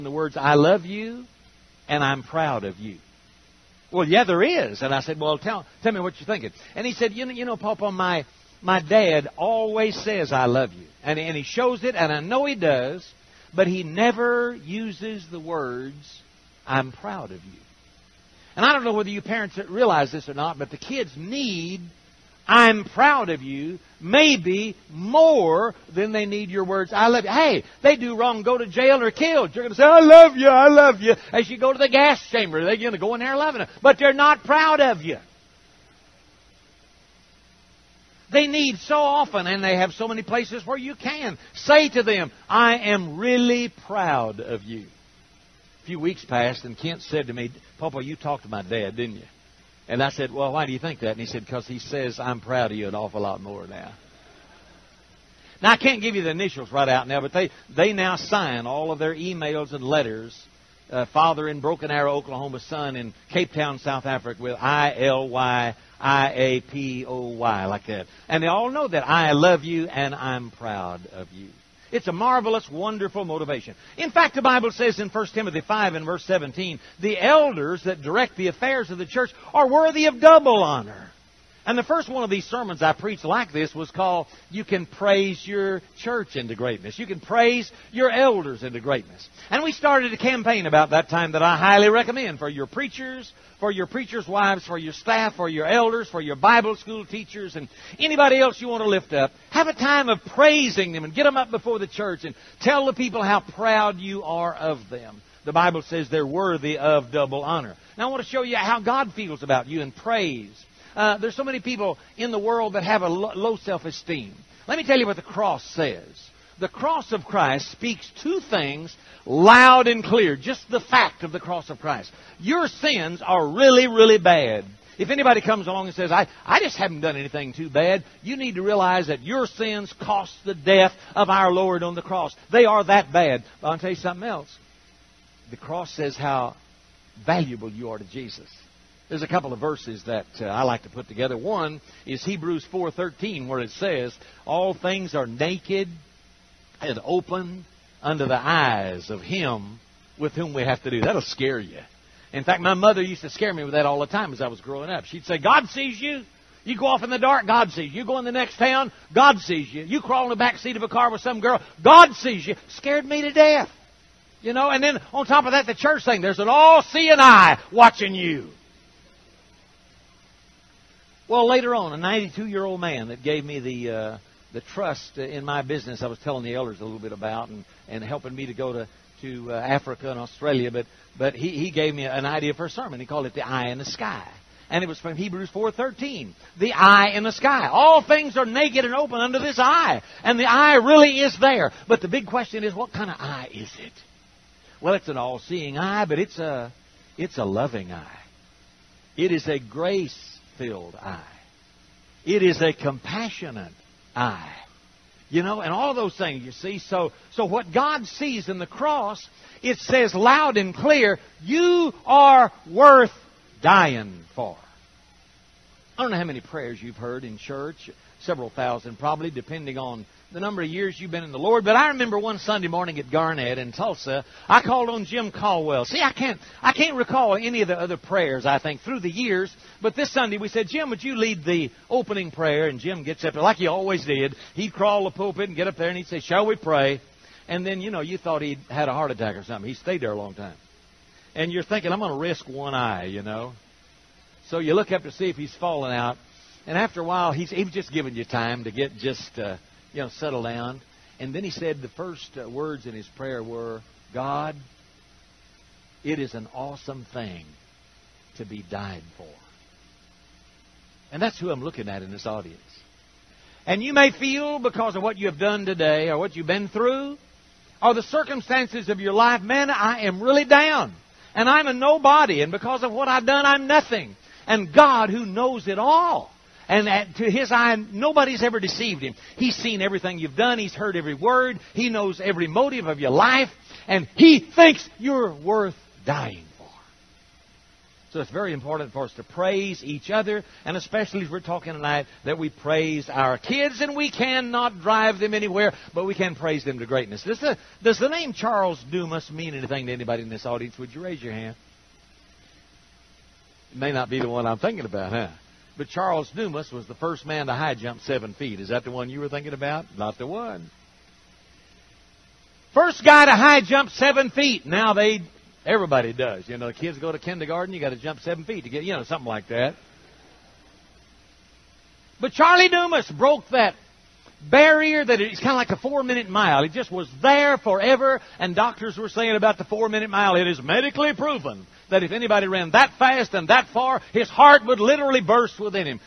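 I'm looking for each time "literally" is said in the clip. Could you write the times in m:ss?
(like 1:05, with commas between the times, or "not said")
5:34.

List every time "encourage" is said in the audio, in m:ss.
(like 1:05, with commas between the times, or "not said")
not said.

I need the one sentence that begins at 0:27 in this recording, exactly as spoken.
Hey, they do wrong, go to jail or killed.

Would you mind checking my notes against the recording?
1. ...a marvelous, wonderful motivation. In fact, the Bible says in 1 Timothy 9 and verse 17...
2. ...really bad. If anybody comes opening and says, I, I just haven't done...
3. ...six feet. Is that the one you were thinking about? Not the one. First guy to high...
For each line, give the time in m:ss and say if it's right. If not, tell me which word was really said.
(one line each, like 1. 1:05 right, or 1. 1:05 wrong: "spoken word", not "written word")
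1. 1:12 wrong: "5", not "9"
2. 2:03 wrong: "along", not "opening"
3. 5:08 wrong: "seven", not "six".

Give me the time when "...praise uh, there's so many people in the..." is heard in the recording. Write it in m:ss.
1:49.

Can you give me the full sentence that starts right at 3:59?
He stayed there a long time.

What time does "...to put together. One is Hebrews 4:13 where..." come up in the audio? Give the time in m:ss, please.
2:20.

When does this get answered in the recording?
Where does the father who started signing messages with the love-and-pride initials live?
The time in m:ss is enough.
1:01.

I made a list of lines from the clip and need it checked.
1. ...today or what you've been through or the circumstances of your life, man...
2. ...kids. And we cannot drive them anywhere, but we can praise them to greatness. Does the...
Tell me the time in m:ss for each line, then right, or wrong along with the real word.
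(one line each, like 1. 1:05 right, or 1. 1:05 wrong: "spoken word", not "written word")
1. 4:25 right
2. 4:53 right.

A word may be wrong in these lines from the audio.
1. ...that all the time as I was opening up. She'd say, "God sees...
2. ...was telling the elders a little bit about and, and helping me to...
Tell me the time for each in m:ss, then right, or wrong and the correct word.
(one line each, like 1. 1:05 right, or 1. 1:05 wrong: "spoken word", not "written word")
1. 2:33 wrong: "growing", not "opening"
2. 2:56 right.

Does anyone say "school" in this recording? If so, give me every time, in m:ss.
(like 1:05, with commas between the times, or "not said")
1:36.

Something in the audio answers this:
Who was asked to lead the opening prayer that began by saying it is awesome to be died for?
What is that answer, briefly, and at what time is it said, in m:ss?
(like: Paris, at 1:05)
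Jim Caldwell, at 3:45.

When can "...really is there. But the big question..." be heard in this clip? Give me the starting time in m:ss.
3:10.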